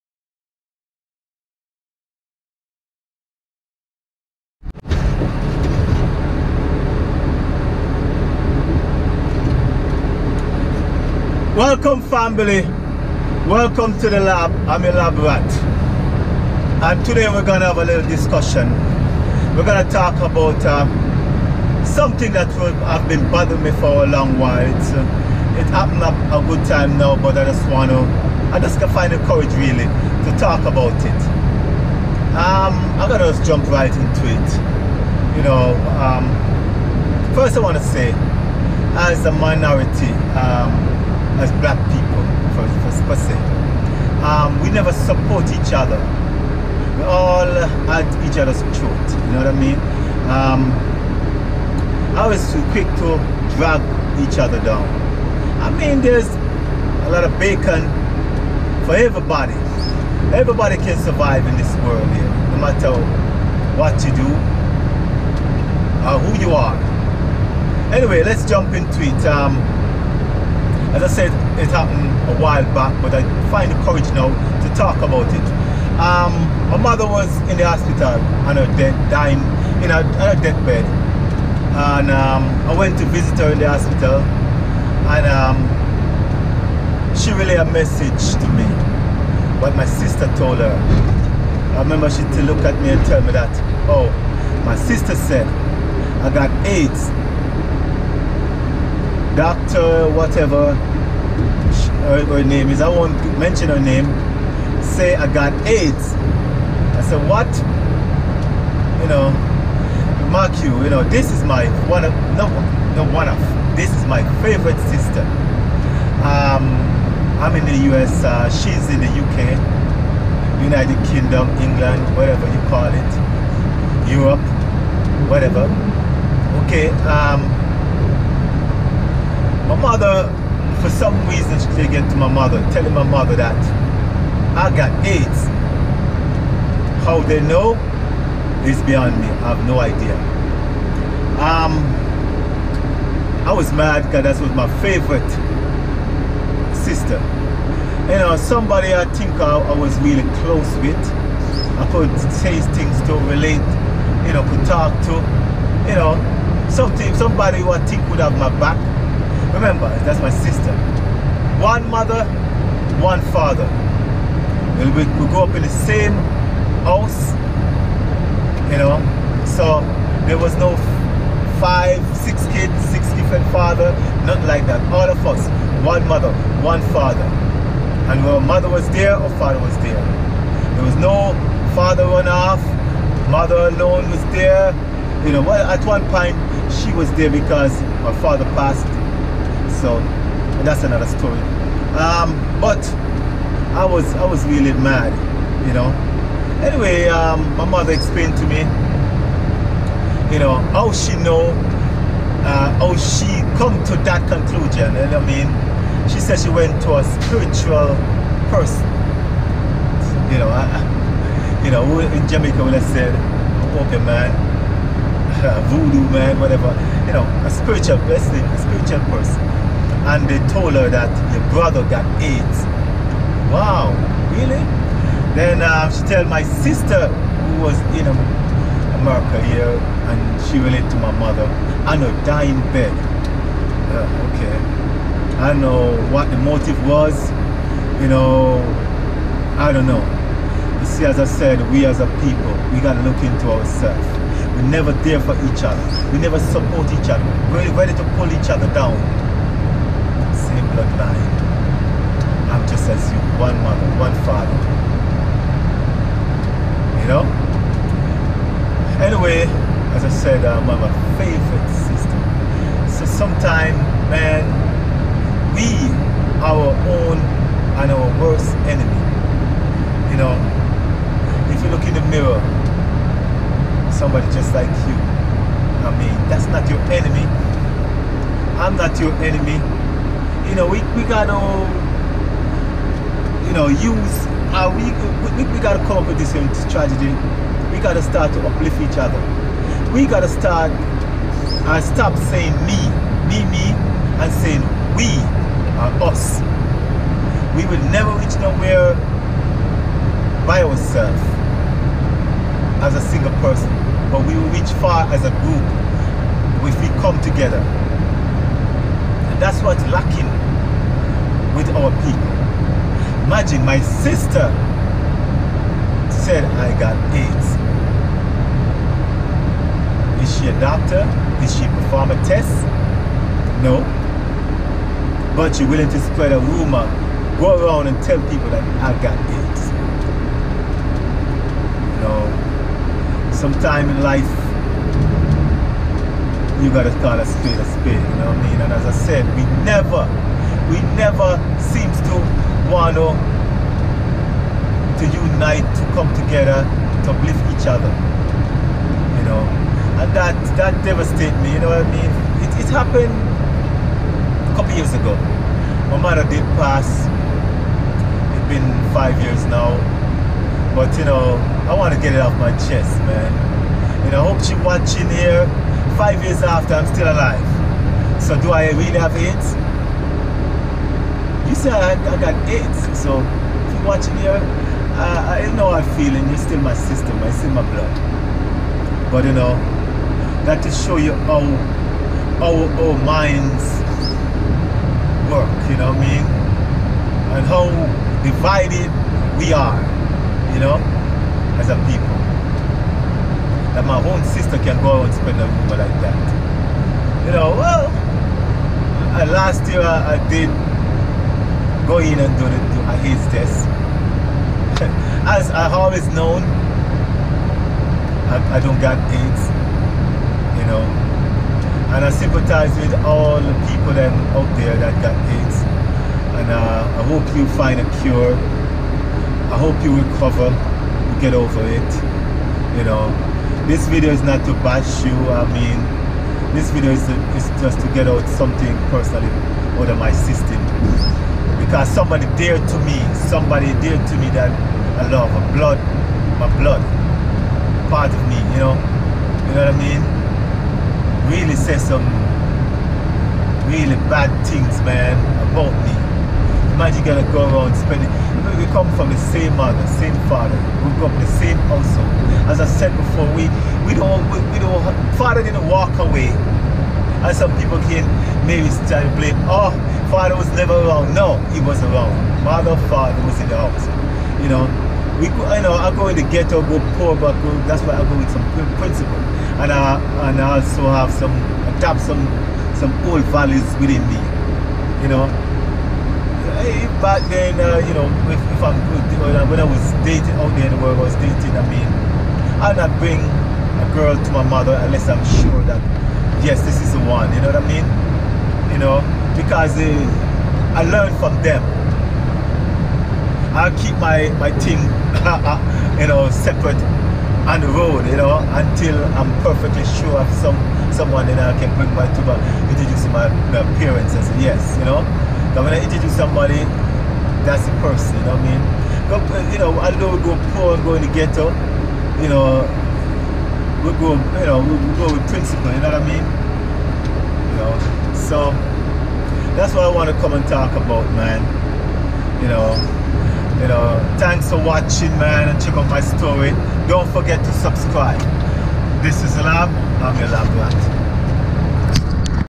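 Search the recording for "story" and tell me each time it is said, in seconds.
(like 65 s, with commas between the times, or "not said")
191 s, 525 s.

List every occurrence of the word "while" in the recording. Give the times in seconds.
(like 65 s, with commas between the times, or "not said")
24 s, 72 s.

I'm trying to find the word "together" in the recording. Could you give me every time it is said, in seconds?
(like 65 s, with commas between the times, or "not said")
307 s, 346 s.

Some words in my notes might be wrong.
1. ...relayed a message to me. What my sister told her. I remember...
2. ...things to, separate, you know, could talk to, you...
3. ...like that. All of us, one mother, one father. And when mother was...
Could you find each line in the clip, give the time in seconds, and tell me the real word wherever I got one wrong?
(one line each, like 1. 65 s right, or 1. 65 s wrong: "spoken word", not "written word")
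1. 87 s right
2. 152 s wrong: "relate", not "separate"
3. 174 s right.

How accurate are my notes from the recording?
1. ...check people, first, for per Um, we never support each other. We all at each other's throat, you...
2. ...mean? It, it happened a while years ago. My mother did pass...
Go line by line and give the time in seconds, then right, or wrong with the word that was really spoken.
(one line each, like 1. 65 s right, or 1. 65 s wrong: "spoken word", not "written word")
1. 41 s wrong: "black", not "check"
2. 351 s wrong: "couple", not "while".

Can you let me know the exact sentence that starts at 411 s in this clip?
And I sympathize with all the people out there that got AIDS.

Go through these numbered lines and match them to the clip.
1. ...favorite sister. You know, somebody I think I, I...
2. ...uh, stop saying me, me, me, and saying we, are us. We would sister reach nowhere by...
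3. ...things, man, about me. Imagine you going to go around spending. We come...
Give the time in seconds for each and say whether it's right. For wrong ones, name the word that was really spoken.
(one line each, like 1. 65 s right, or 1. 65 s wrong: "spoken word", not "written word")
1. 144 s right
2. 291 s wrong: "never", not "sister"
3. 444 s right.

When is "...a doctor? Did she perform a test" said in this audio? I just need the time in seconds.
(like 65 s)
320 s.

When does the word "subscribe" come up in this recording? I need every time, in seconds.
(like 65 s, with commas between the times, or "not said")
527 s.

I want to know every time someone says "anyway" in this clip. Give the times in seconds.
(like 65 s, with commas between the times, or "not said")
67 s, 196 s.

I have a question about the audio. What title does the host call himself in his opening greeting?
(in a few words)
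lab rat.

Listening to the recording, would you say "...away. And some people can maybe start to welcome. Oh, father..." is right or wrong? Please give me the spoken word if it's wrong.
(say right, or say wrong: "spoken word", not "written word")
wrong: "blame", not "welcome".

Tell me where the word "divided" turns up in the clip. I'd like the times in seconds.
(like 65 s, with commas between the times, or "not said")
388 s.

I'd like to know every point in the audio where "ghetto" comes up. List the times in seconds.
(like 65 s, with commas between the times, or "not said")
466 s, 511 s.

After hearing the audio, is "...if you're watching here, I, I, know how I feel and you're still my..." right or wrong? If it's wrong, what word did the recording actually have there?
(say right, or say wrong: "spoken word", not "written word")
right.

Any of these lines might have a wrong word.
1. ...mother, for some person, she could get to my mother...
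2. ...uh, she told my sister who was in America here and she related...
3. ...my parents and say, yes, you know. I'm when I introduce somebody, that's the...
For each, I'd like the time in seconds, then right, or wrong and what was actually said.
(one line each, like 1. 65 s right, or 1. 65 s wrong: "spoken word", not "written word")
1. 129 s wrong: "reason", not "person"
2. 225 s right
3. 503 s right.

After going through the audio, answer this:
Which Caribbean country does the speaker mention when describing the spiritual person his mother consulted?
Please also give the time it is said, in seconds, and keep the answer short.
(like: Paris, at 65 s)
Jamaica, at 212 s.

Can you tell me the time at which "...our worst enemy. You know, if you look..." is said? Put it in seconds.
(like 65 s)
267 s.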